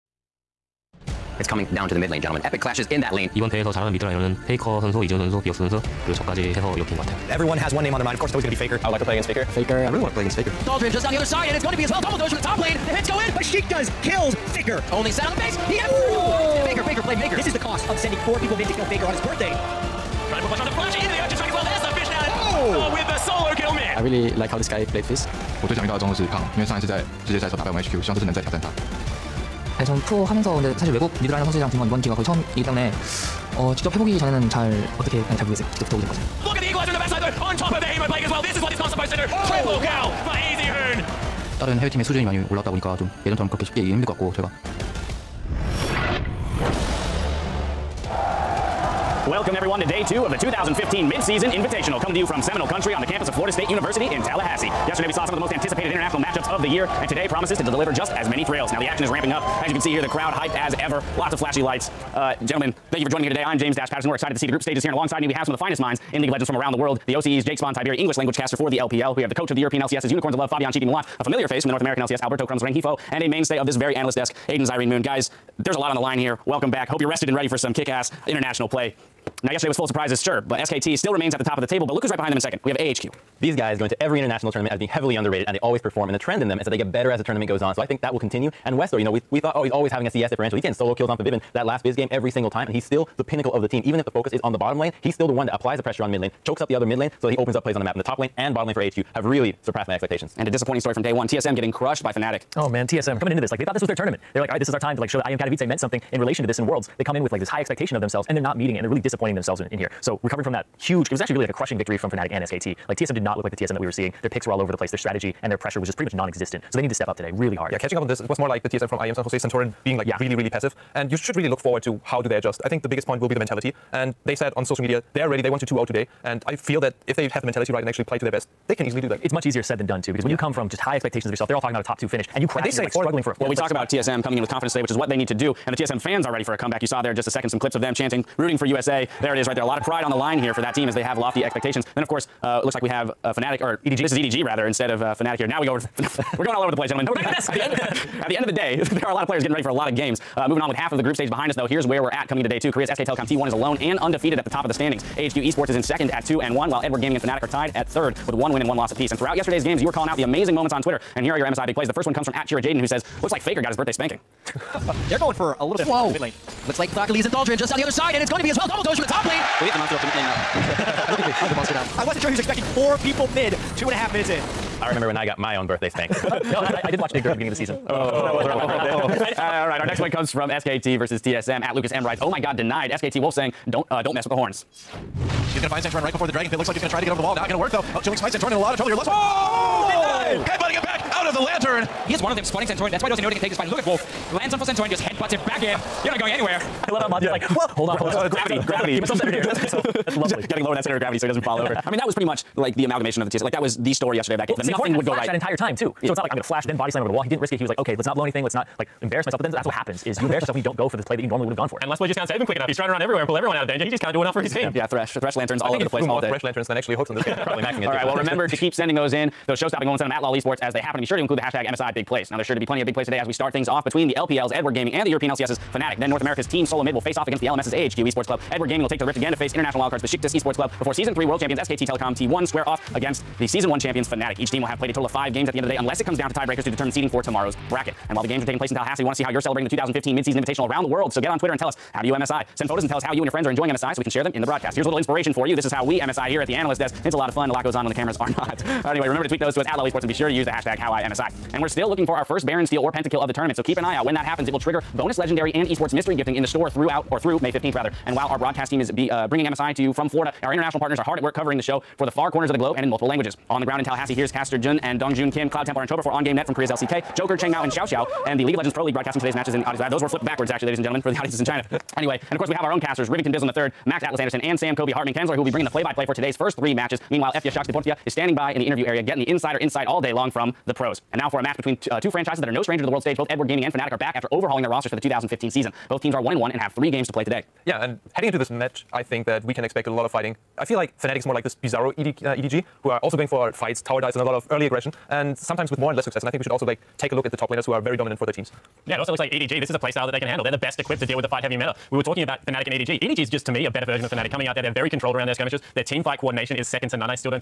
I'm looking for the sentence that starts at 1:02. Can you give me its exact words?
Uh, gentlemen, Thank you for joining me here today.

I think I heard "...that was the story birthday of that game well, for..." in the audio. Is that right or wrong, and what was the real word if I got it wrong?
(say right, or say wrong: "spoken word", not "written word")
wrong: "yesterday", not "birthday".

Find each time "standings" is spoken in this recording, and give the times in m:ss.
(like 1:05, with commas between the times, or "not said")
2:34, 4:38.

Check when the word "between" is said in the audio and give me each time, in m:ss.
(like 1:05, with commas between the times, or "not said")
3:43, 4:41.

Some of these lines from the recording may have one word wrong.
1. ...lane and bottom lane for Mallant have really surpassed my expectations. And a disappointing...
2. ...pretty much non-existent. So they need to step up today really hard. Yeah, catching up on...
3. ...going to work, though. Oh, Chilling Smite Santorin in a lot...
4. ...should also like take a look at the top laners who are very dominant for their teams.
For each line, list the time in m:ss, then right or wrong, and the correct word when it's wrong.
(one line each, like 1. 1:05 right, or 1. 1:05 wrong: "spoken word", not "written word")
1. 1:38 wrong: "AHQ", not "Mallant"
2. 1:55 right
3. 3:07 right
4. 4:56 right.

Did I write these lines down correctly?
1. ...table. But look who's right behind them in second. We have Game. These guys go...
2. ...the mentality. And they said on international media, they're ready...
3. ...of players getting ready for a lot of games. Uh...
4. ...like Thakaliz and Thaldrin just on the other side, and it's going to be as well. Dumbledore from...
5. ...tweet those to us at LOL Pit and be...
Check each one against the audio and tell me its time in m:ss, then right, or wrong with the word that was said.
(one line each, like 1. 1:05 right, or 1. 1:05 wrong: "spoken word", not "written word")
1. 1:21 wrong: "AHQ", not "Game"
2. 2:03 wrong: "social", not "international"
3. 2:29 right
4. 2:46 right
5. 4:09 wrong: "Esports", not "Pit".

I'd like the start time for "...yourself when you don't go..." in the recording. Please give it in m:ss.
3:30.